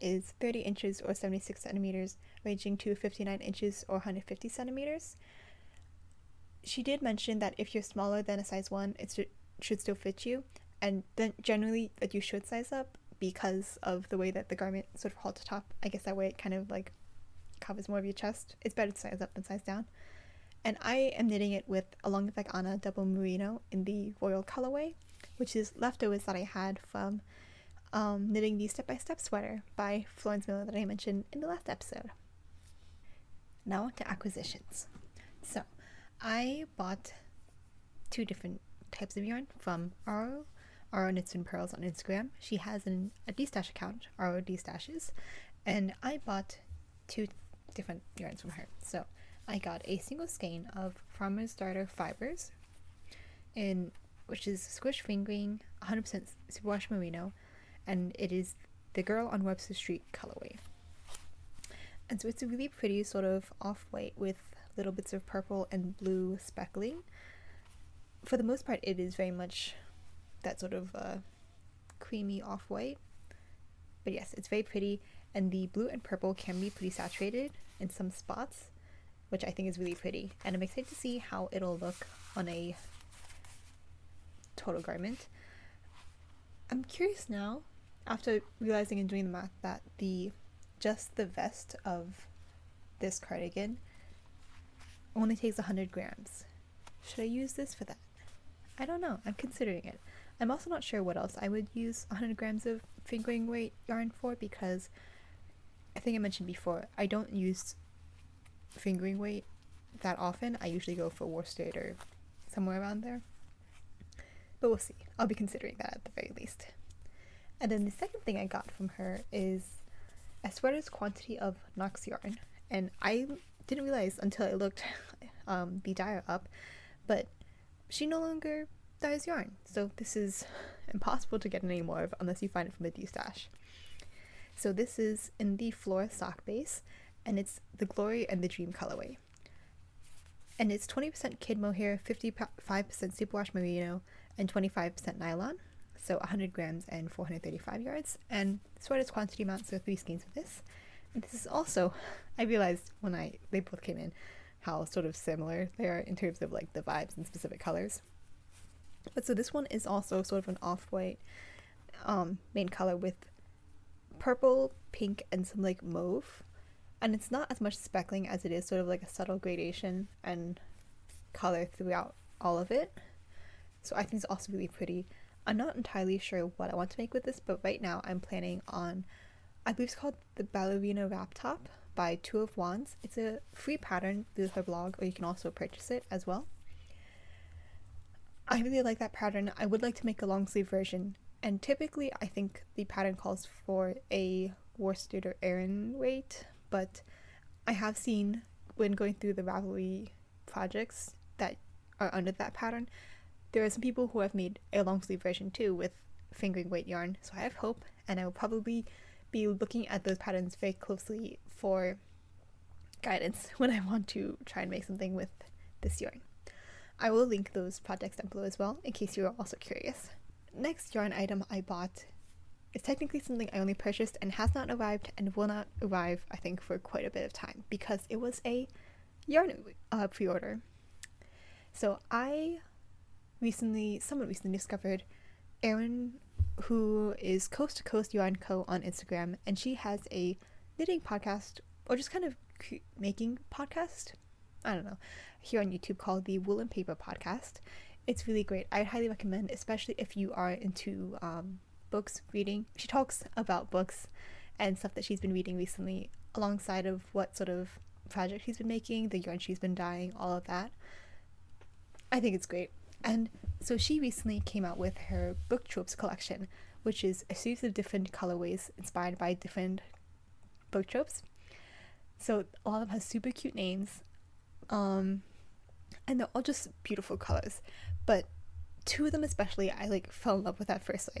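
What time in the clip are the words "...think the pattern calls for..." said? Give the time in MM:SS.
03:12.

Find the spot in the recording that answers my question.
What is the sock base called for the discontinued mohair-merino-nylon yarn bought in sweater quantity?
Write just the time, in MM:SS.
02:15.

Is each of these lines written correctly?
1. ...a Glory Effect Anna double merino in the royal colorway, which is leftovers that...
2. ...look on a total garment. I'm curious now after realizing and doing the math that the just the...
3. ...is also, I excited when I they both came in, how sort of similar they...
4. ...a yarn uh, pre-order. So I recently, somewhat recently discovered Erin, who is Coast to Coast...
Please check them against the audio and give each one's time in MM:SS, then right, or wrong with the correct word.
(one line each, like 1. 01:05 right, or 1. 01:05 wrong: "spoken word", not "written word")
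1. 00:22 wrong: "Long", not "Glory"
2. 01:21 right
3. 02:31 wrong: "realized", not "excited"
4. 03:48 right.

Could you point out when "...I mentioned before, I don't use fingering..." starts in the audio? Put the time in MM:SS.
01:46.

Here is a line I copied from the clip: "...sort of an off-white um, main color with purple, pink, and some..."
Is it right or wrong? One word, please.
right.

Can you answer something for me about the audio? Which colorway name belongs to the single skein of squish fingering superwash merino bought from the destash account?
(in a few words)
Girl on Webster Street.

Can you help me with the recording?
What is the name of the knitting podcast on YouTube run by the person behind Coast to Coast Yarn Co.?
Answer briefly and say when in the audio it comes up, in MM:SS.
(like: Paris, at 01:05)
Wool and Paper Podcast, at 04:06.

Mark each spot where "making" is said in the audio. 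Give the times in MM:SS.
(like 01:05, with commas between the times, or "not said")
04:02, 04:18.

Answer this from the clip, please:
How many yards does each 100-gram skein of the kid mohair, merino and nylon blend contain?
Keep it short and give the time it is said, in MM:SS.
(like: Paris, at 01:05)
435, at 02:27.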